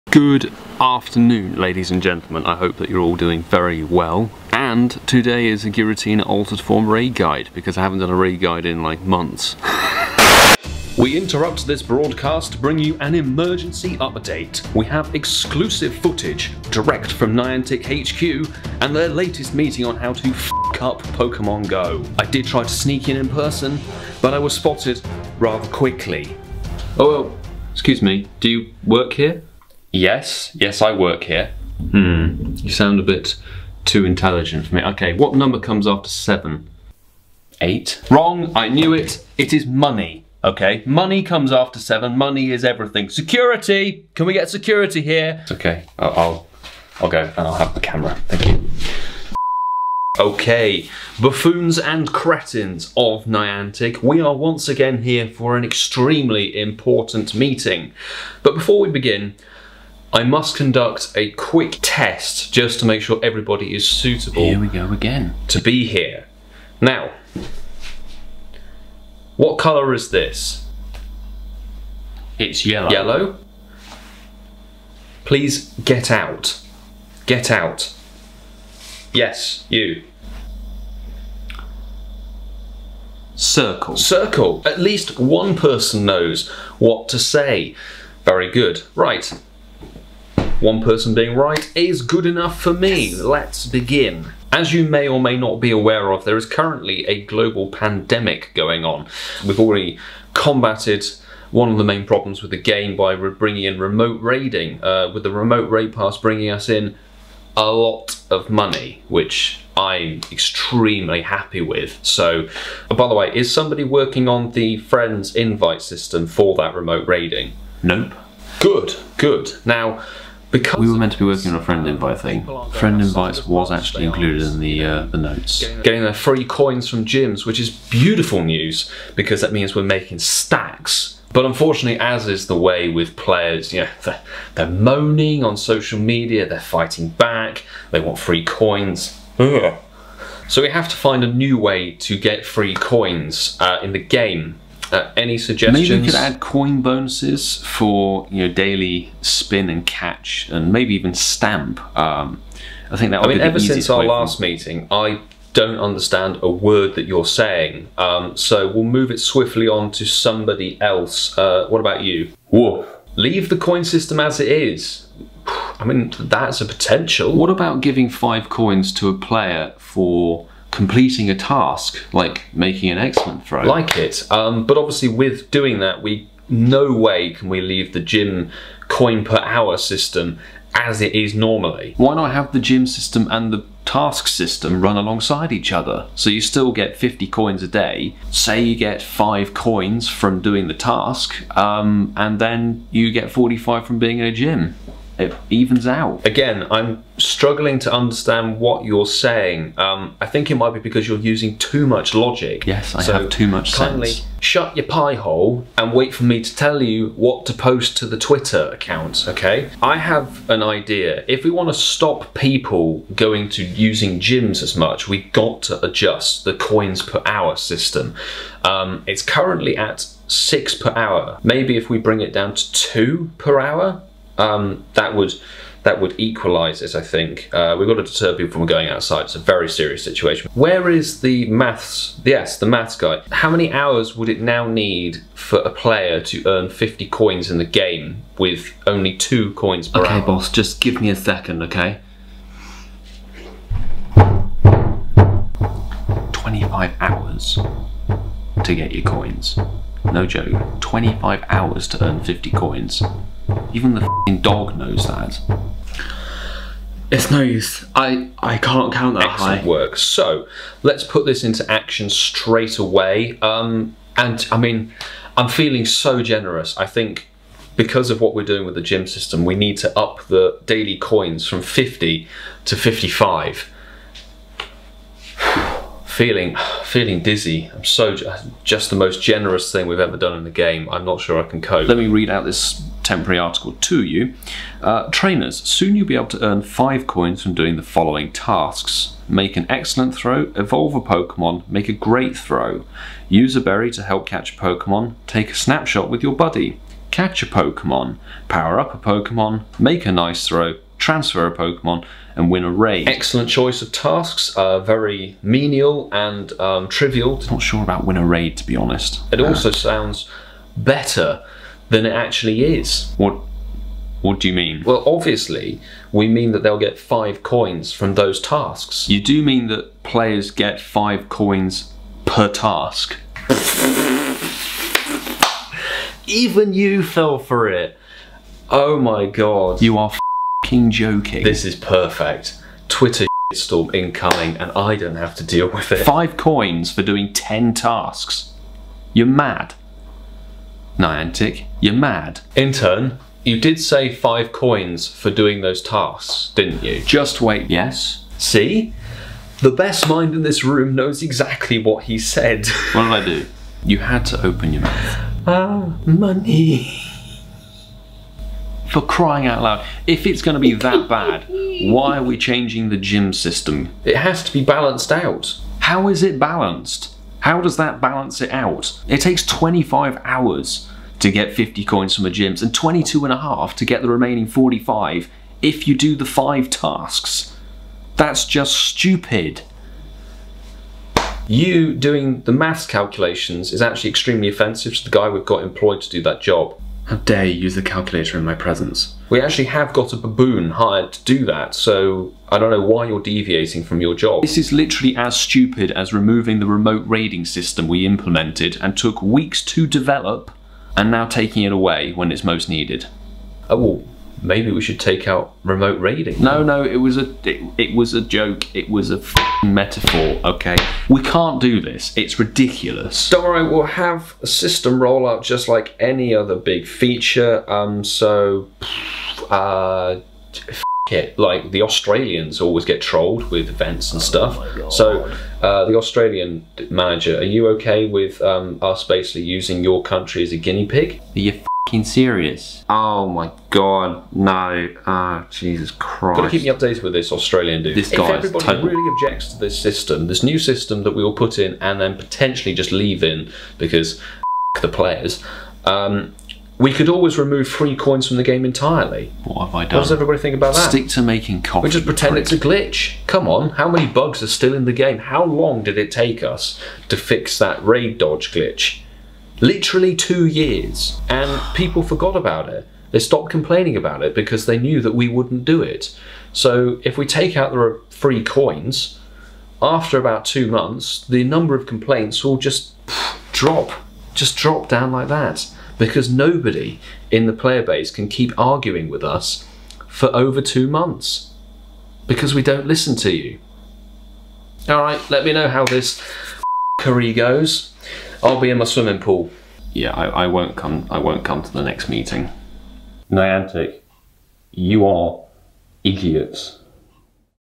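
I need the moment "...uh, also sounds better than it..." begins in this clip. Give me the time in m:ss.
5:09.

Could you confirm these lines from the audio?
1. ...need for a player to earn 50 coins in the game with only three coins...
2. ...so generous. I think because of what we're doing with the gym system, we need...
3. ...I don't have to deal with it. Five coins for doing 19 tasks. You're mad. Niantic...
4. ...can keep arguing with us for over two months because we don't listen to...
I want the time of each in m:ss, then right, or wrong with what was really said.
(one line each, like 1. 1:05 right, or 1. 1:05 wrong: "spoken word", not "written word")
1. 3:54 wrong: "two", not "three"
2. 4:25 right
3. 5:34 wrong: "10", not "19"
4. 7:58 right.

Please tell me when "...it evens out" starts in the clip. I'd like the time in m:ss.
3:15.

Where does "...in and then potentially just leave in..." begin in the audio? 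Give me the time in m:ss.
7:21.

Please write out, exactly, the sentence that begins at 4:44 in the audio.
Uh, trainers, soon you'll be able to earn 5 coins from doing the following tasks.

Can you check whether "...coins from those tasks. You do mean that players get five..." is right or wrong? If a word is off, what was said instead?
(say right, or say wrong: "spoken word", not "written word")
right.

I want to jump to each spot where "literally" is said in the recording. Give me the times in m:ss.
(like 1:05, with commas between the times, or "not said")
6:34, 7:39.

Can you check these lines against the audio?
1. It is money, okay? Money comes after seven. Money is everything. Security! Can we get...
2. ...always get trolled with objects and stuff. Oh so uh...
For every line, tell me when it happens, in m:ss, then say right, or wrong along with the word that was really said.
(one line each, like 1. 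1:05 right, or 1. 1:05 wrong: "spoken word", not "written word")
1. 0:39 right
2. 7:02 wrong: "events", not "objects".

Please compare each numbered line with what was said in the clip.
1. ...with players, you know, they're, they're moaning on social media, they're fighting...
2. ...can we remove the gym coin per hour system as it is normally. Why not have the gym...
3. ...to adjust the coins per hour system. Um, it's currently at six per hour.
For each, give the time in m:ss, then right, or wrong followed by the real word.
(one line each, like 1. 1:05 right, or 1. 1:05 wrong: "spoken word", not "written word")
1. 2:12 right
2. 2:57 wrong: "leave", not "remove"
3. 3:35 right.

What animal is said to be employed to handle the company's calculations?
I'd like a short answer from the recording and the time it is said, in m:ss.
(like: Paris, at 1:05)
Baboon, at 6:30.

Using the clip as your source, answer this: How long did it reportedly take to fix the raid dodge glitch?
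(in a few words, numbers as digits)
2 years.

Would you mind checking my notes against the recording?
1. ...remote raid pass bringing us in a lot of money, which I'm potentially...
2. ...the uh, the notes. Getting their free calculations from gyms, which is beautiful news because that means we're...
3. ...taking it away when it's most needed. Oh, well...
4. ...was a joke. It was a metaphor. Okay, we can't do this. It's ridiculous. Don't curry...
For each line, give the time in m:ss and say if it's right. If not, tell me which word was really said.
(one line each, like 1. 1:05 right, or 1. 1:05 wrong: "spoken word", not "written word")
1. 1:45 wrong: "extremely", not "potentially"
2. 2:04 wrong: "coins", not "calculations"
3. 6:41 right
4. 6:47 wrong: "worry", not "curry".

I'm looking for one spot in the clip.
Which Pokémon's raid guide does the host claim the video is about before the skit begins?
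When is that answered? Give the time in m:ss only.
0:05.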